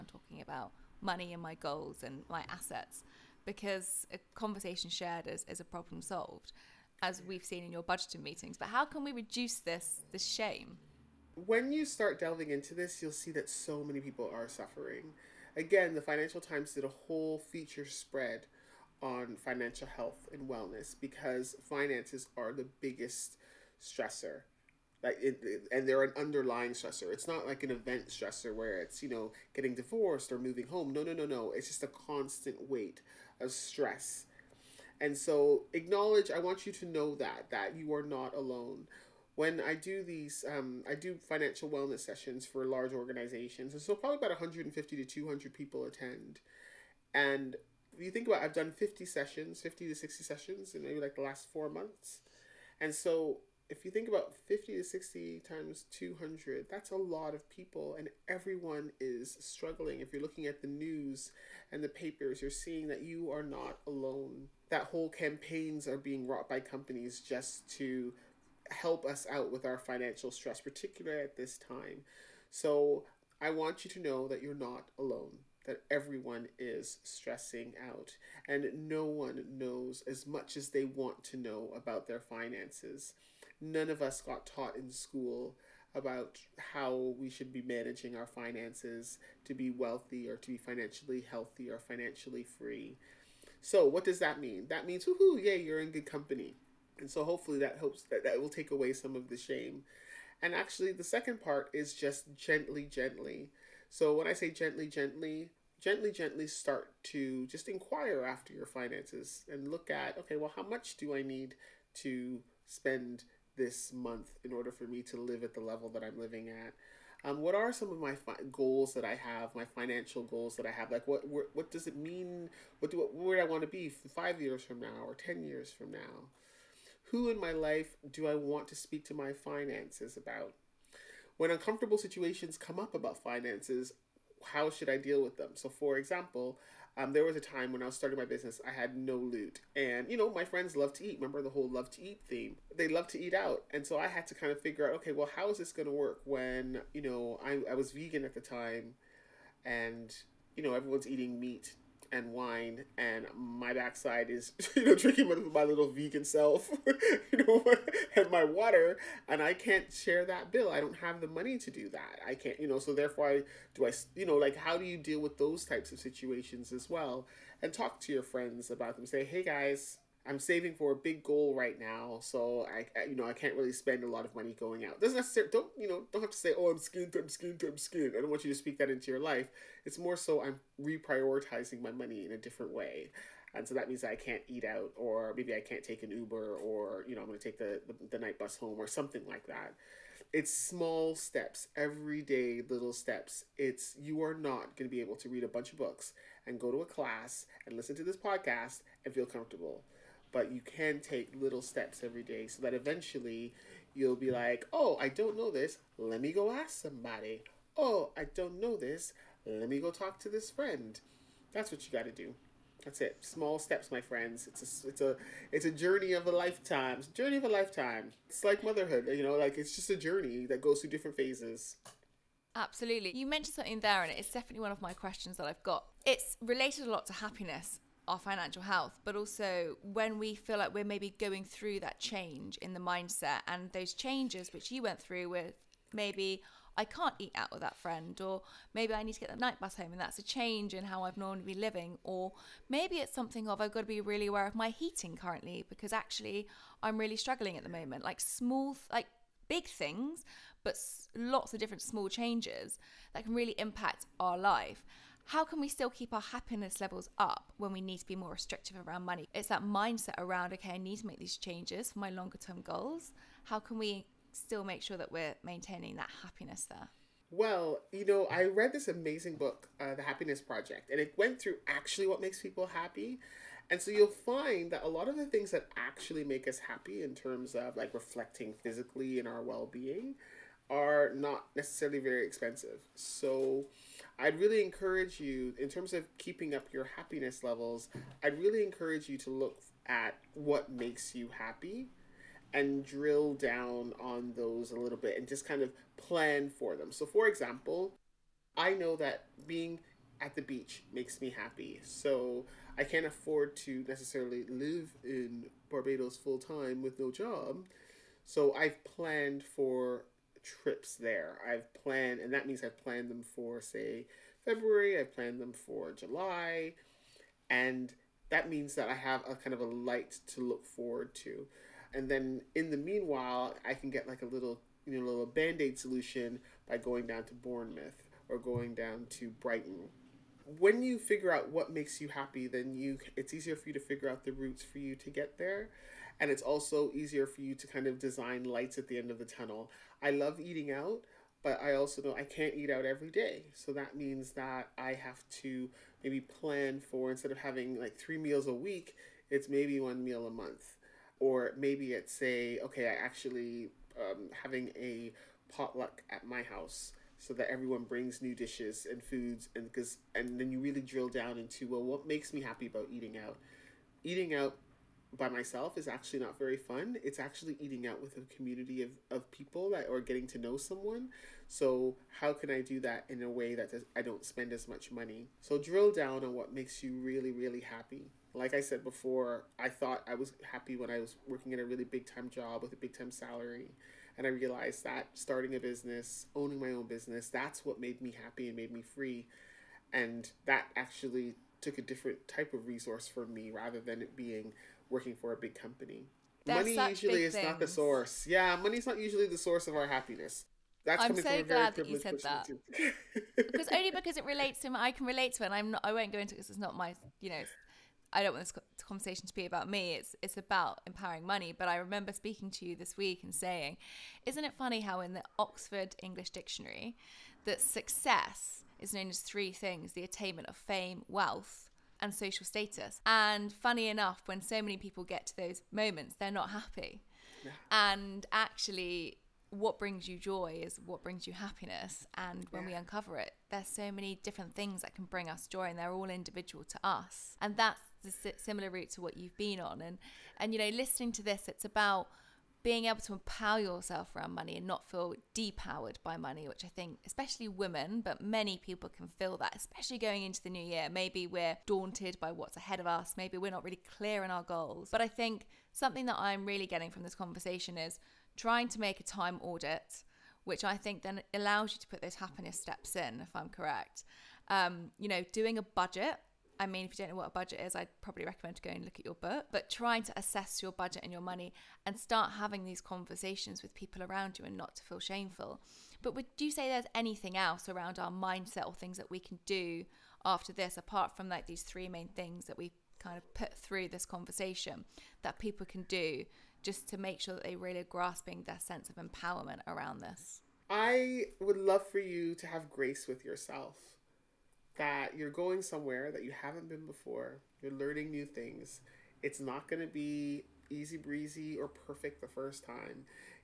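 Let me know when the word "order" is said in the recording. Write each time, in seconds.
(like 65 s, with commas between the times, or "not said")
114 s.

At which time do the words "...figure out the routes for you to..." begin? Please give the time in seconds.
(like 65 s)
333 s.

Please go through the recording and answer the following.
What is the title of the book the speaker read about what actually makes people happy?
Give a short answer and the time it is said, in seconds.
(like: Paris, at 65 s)
The Happiness Project, at 269 s.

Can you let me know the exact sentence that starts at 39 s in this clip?
When I do these, um, I do financial wellness sessions for large organizations.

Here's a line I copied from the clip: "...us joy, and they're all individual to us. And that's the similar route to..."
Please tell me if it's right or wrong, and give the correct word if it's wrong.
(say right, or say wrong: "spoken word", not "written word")
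right.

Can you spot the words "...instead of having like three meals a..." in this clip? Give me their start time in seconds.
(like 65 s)
347 s.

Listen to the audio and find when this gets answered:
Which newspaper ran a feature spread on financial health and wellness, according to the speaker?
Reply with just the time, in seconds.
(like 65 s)
16 s.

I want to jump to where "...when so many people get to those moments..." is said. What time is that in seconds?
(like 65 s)
424 s.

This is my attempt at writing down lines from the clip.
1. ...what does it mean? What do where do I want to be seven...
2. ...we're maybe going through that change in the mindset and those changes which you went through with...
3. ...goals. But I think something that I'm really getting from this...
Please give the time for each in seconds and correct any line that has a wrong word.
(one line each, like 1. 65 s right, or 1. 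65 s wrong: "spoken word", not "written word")
1. 121 s wrong: "five", not "seven"
2. 230 s right
3. 454 s right.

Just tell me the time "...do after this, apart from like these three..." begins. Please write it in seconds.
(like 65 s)
479 s.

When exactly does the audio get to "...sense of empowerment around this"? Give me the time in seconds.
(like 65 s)
488 s.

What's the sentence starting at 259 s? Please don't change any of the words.
It's that mindset around, okay, I need to make these changes for my longer term goals.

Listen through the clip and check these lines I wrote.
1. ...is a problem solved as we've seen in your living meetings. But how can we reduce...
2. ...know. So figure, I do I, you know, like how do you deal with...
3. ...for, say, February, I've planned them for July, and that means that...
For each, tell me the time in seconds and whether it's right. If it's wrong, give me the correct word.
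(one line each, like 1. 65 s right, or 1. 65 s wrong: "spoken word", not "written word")
1. 5 s wrong: "budgeting", not "living"
2. 162 s wrong: "therefore", not "figure"
3. 313 s right.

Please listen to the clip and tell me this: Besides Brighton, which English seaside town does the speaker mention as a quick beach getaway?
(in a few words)
Bournemouth.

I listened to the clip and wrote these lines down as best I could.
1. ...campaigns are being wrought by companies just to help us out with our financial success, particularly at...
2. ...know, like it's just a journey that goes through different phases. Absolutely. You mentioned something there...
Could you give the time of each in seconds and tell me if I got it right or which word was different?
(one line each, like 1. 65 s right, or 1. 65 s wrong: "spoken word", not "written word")
1. 65 s wrong: "stress", not "success"
2. 219 s right.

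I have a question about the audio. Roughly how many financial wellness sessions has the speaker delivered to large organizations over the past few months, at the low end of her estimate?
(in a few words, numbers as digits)
50.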